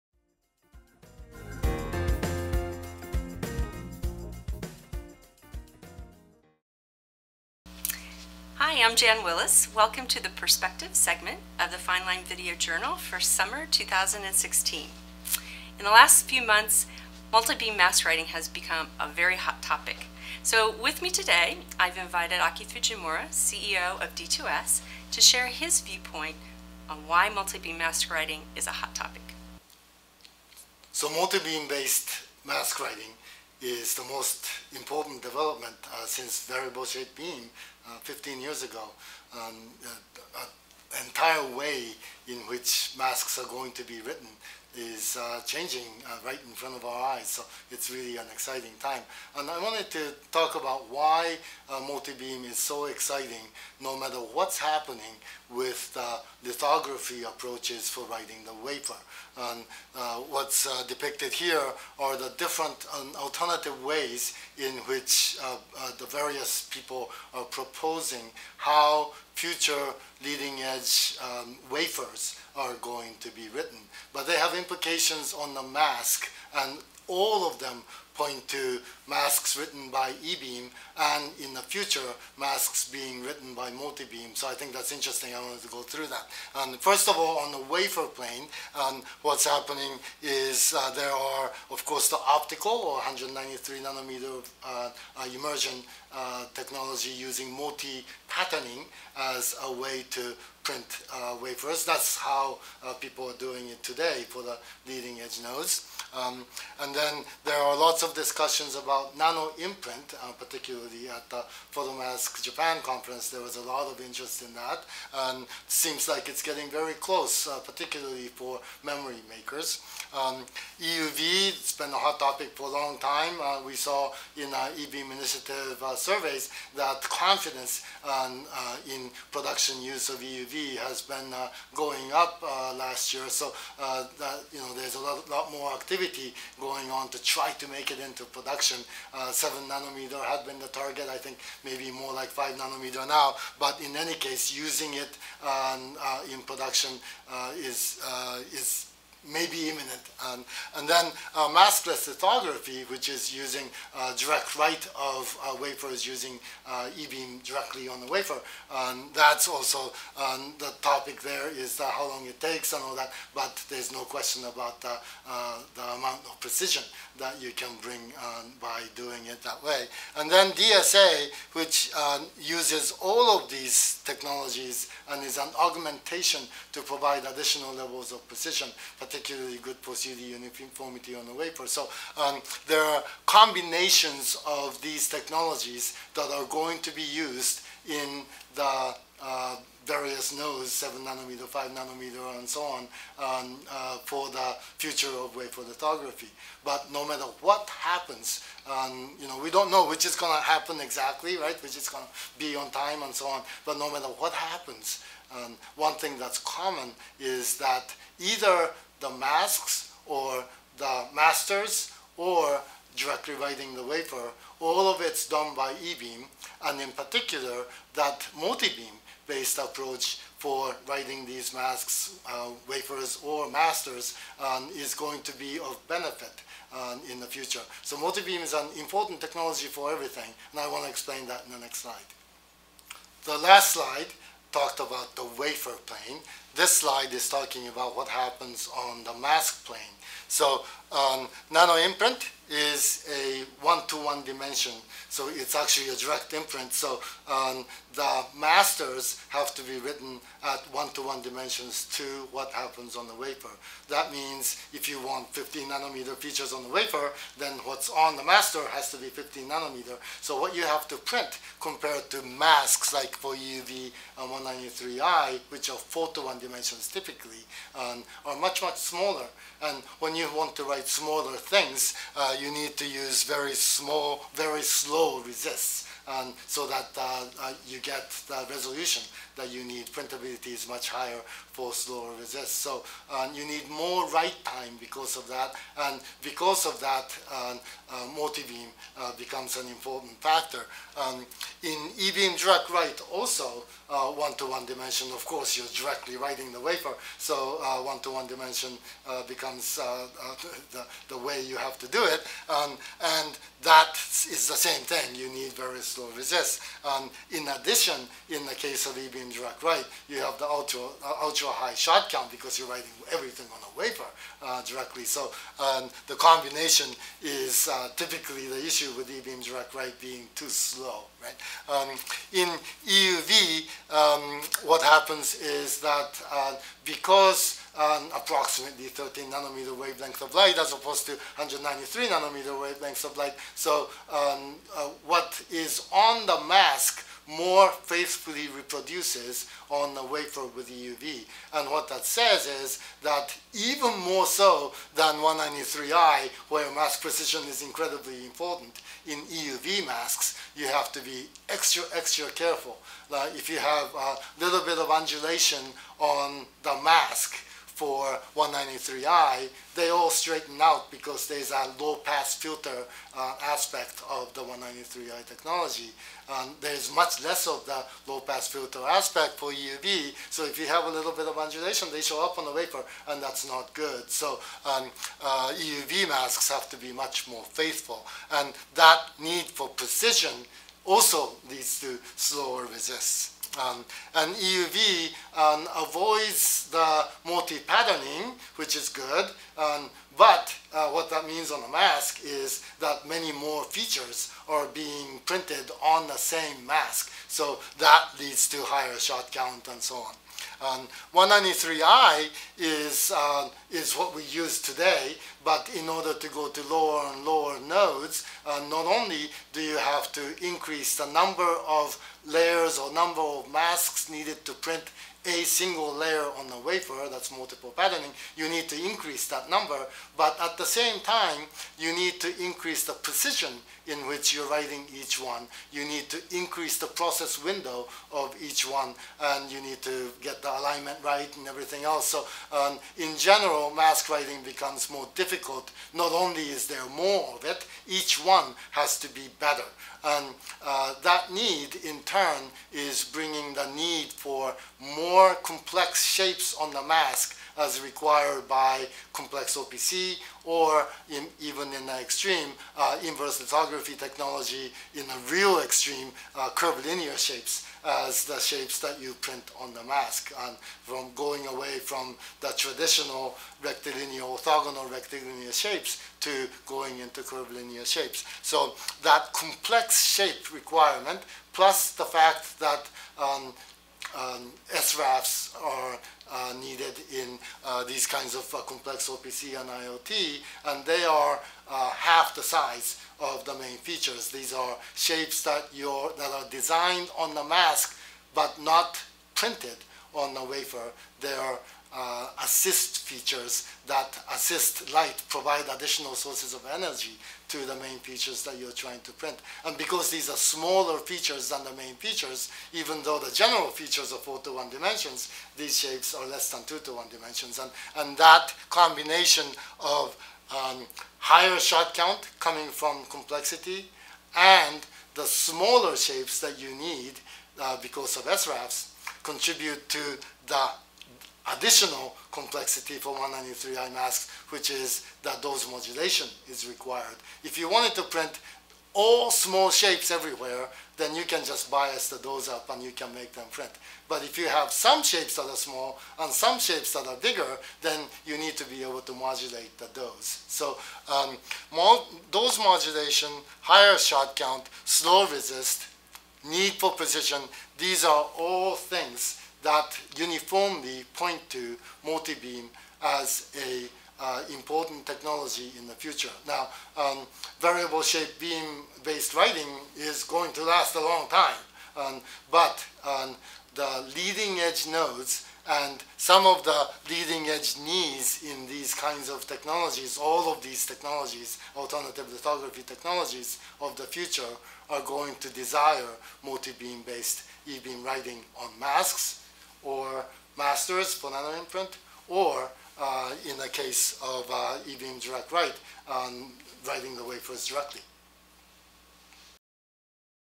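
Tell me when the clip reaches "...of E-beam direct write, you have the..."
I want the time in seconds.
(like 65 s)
308 s.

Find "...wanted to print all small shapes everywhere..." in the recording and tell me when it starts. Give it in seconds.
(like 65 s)
527 s.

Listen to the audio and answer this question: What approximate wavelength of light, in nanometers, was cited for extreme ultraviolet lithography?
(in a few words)
13 nanometers.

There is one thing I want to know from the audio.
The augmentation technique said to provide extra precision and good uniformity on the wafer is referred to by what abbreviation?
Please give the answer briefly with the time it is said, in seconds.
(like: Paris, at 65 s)
DSA, at 170 s.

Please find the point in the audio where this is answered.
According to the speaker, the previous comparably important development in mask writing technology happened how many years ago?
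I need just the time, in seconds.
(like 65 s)
37 s.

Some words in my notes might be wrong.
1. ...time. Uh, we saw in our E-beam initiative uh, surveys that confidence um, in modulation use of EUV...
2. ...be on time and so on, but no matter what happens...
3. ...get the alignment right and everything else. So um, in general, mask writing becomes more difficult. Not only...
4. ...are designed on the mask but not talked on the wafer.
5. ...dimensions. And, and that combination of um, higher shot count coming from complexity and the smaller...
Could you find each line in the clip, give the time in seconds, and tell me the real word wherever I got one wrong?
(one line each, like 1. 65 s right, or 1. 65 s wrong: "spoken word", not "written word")
1. 122 s wrong: "production", not "modulation"
2. 202 s right
3. 430 s right
4. 486 s wrong: "printed", not "talked"
5. 507 s right.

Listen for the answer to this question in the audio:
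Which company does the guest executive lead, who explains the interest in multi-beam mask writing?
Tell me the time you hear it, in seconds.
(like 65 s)
24 s.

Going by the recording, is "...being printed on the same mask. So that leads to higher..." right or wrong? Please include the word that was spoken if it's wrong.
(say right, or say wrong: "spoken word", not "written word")
right.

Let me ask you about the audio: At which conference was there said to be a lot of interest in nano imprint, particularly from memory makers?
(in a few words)
Photomask Japan.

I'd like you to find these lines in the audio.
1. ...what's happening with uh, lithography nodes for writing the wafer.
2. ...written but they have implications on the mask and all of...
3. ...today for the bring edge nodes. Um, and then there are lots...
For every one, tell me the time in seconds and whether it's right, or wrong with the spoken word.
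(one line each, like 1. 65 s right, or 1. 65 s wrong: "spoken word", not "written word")
1. 54 s wrong: "approaches", not "nodes"
2. 73 s right
3. 103 s wrong: "leading", not "bring".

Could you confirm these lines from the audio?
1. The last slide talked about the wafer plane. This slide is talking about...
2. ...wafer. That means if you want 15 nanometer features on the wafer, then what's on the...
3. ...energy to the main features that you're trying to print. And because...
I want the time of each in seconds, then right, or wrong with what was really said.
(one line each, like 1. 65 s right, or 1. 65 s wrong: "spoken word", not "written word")
1. 233 s right
2. 253 s right
3. 496 s right.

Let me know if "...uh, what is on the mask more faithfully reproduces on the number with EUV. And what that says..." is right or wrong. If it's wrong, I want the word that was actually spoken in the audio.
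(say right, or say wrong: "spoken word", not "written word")
wrong: "wafer", not "number".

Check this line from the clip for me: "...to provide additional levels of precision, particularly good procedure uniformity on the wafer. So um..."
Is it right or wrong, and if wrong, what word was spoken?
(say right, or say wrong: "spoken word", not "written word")
right.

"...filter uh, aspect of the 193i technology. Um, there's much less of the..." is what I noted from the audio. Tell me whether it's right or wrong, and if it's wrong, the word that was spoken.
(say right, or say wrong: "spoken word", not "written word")
right.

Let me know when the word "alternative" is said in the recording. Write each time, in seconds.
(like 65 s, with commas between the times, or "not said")
63 s, 571 s.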